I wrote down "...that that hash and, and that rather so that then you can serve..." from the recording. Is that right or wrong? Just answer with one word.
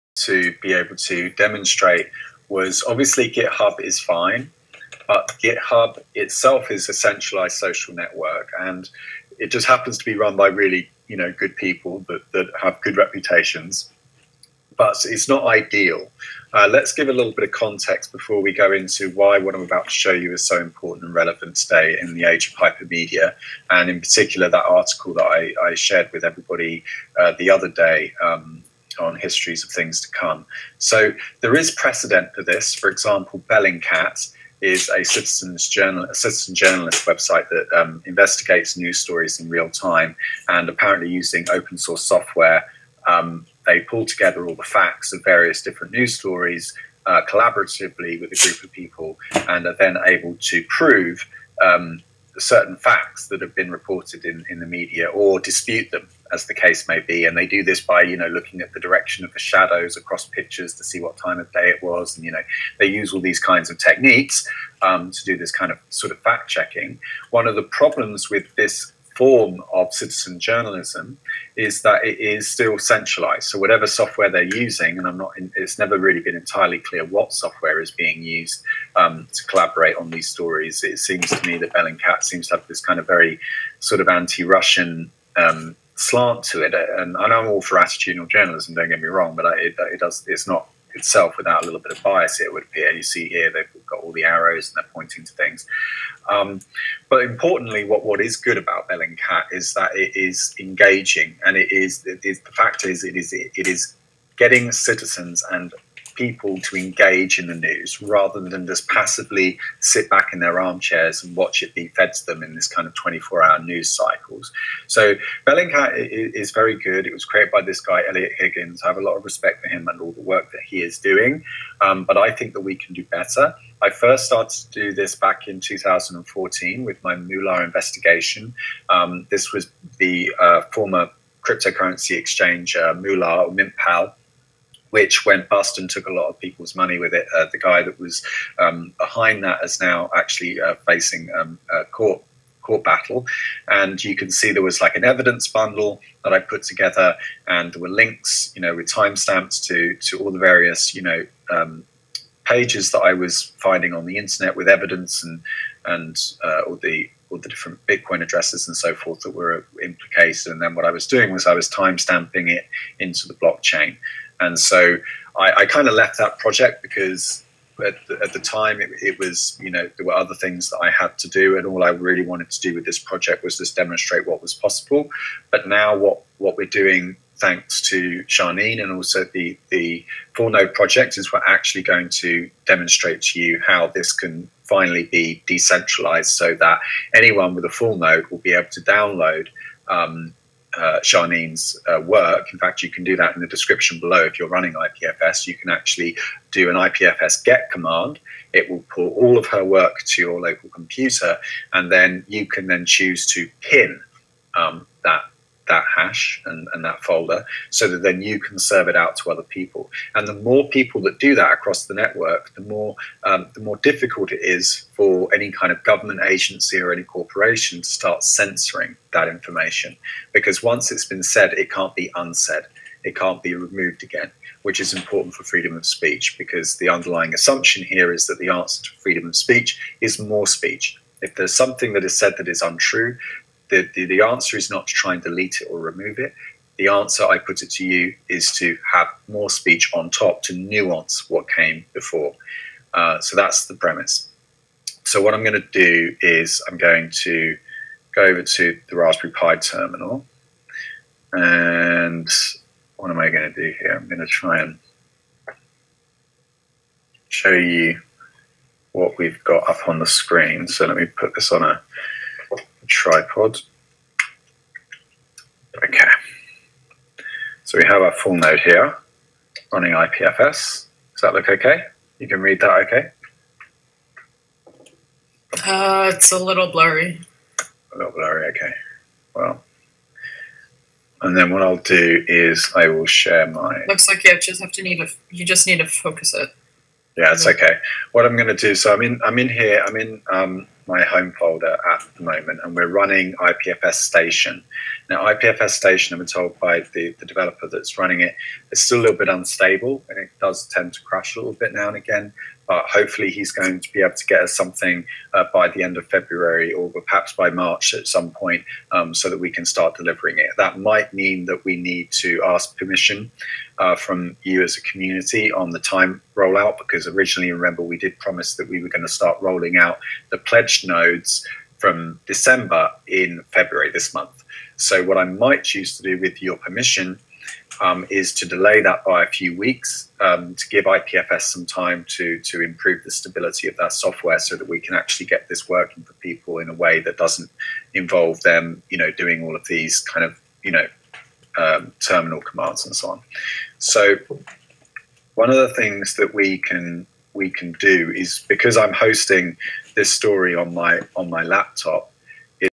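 wrong.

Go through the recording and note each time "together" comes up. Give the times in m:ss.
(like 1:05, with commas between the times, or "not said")
0:44, 2:26.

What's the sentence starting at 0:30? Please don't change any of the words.
So there is precedent for this.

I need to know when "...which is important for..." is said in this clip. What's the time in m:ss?
3:44.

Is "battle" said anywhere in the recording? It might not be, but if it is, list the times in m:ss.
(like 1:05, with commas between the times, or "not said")
2:22.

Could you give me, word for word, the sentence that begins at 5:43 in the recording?
So one of the things that we can we can do is because I'm hosting this story on my on my laptop.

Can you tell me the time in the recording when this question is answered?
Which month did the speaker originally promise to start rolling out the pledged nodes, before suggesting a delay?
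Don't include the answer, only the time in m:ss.
5:22.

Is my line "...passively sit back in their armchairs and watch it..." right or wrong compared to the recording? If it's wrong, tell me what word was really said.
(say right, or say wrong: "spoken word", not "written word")
right.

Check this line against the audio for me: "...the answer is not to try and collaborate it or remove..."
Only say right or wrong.
wrong.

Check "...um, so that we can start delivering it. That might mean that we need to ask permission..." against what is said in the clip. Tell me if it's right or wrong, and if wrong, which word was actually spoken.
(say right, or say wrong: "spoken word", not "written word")
right.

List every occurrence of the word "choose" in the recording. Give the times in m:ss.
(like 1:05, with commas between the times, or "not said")
3:22, 5:25.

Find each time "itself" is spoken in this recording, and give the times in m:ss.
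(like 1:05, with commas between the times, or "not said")
0:06, 1:30.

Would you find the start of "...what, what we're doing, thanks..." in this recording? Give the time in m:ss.
2:55.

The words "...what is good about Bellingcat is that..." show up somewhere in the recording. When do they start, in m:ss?
1:38.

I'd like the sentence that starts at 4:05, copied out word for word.
So what I'm going to do is I'm going to go over to the Raspberry Pi terminal.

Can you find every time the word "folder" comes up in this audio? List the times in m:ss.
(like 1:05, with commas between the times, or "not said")
3:27, 4:51.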